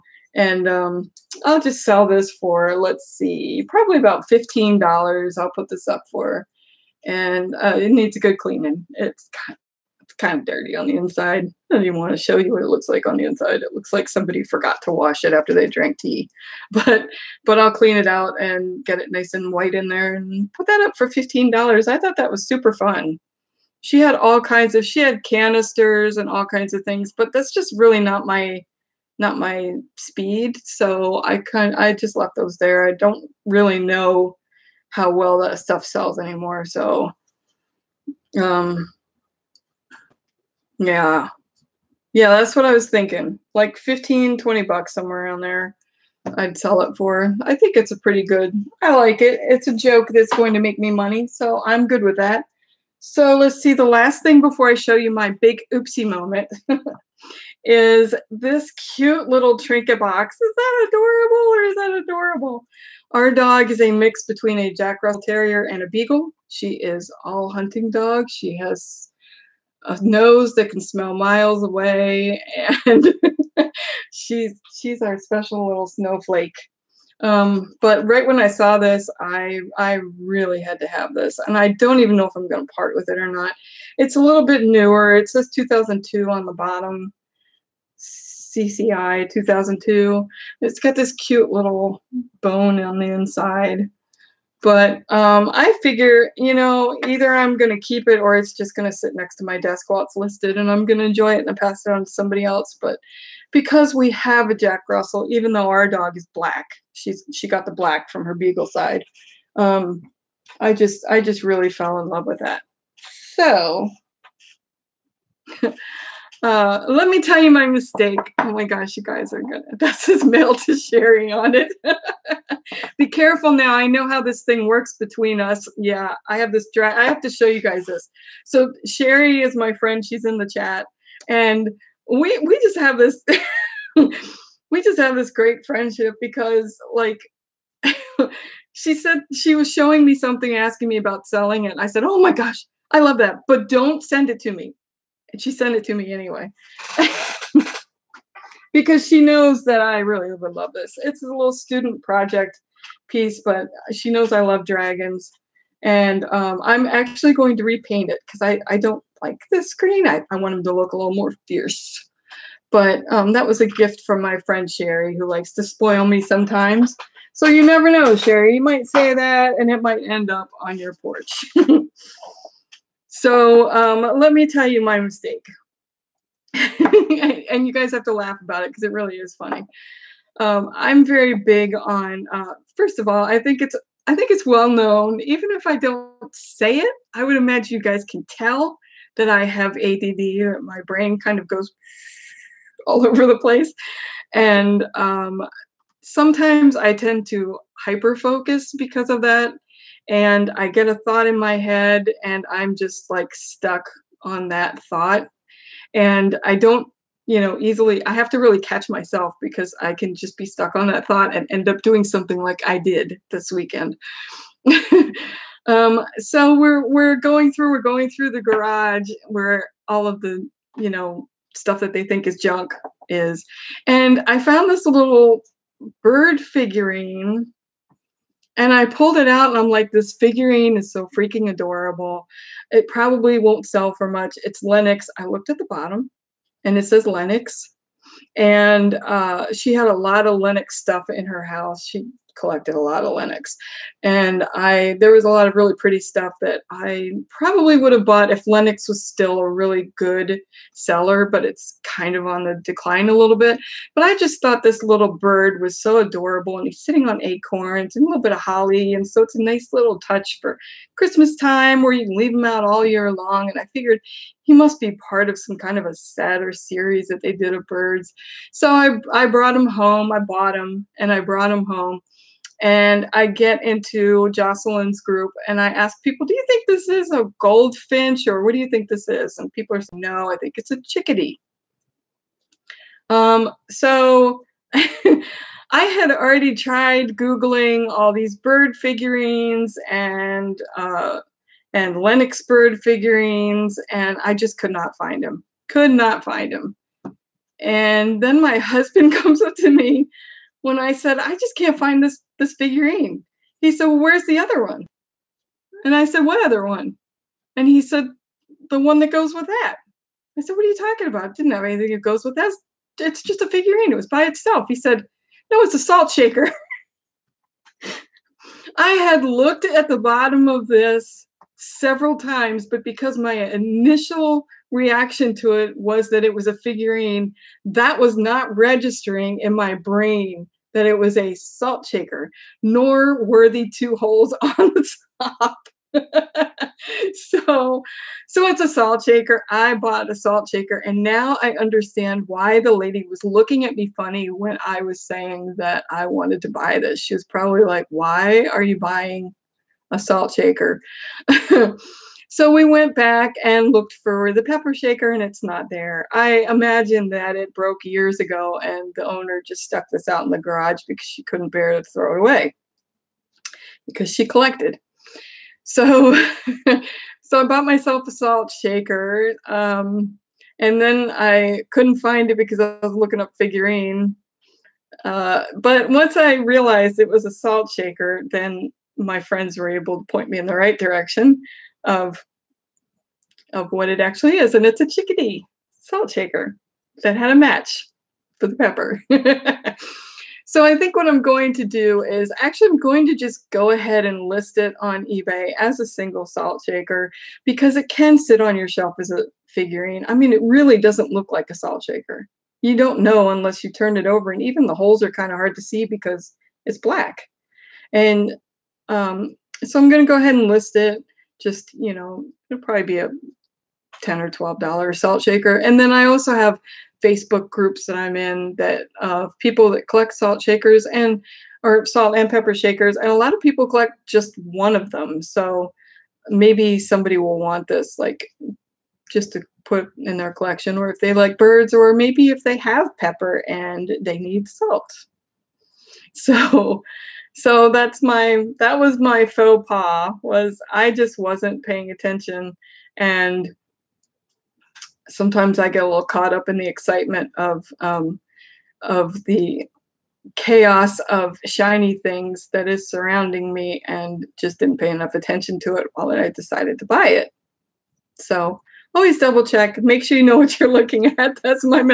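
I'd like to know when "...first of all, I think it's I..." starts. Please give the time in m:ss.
3:02.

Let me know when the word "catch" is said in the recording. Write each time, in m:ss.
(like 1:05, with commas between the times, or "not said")
3:28.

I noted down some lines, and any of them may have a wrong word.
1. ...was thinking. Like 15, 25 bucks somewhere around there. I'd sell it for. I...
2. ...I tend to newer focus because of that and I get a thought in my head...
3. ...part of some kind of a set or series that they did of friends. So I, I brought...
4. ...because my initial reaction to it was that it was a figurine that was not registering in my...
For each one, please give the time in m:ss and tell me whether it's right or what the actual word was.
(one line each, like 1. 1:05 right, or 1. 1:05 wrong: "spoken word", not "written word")
1. 0:42 wrong: "20", not "25"
2. 3:16 wrong: "hyper", not "newer"
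3. 4:25 wrong: "birds", not "friends"
4. 5:22 right.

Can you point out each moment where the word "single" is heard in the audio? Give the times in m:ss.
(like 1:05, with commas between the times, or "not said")
6:35.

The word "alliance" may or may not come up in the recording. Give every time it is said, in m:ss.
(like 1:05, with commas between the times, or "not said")
not said.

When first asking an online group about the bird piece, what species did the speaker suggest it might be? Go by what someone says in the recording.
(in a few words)
goldfinch.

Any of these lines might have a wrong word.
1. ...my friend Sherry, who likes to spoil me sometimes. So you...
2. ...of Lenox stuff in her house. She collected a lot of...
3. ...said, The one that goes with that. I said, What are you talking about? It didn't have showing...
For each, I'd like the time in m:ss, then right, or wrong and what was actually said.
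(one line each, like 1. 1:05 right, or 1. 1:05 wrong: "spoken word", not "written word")
1. 2:44 right
2. 4:00 right
3. 5:07 wrong: "anything", not "showing".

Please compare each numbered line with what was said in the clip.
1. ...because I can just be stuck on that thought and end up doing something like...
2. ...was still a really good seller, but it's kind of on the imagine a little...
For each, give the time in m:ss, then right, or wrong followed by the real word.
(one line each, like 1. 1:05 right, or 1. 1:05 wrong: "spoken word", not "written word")
1. 3:29 right
2. 4:08 wrong: "decline", not "imagine".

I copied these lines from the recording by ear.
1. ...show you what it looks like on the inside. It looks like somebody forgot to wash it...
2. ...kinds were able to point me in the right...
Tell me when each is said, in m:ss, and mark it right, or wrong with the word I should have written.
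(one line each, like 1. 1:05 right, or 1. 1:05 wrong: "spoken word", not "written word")
1. 0:12 right
2. 6:19 wrong: "friends", not "kinds".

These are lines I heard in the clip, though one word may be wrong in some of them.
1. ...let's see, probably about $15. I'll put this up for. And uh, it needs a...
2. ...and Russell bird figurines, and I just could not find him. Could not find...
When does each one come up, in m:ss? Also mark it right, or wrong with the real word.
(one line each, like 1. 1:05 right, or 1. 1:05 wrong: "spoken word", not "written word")
1. 0:02 right
2. 4:51 wrong: "Lenox", not "Russell".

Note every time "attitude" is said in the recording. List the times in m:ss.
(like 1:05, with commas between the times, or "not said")
not said.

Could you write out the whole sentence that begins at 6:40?
I mean, it really doesn't look like a salt shaker.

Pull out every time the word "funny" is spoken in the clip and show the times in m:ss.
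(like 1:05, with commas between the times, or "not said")
2:59, 5:43.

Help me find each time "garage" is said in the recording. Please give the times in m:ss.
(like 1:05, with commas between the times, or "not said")
3:38, 6:00.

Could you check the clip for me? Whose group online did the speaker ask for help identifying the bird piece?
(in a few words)
Jocelyn's.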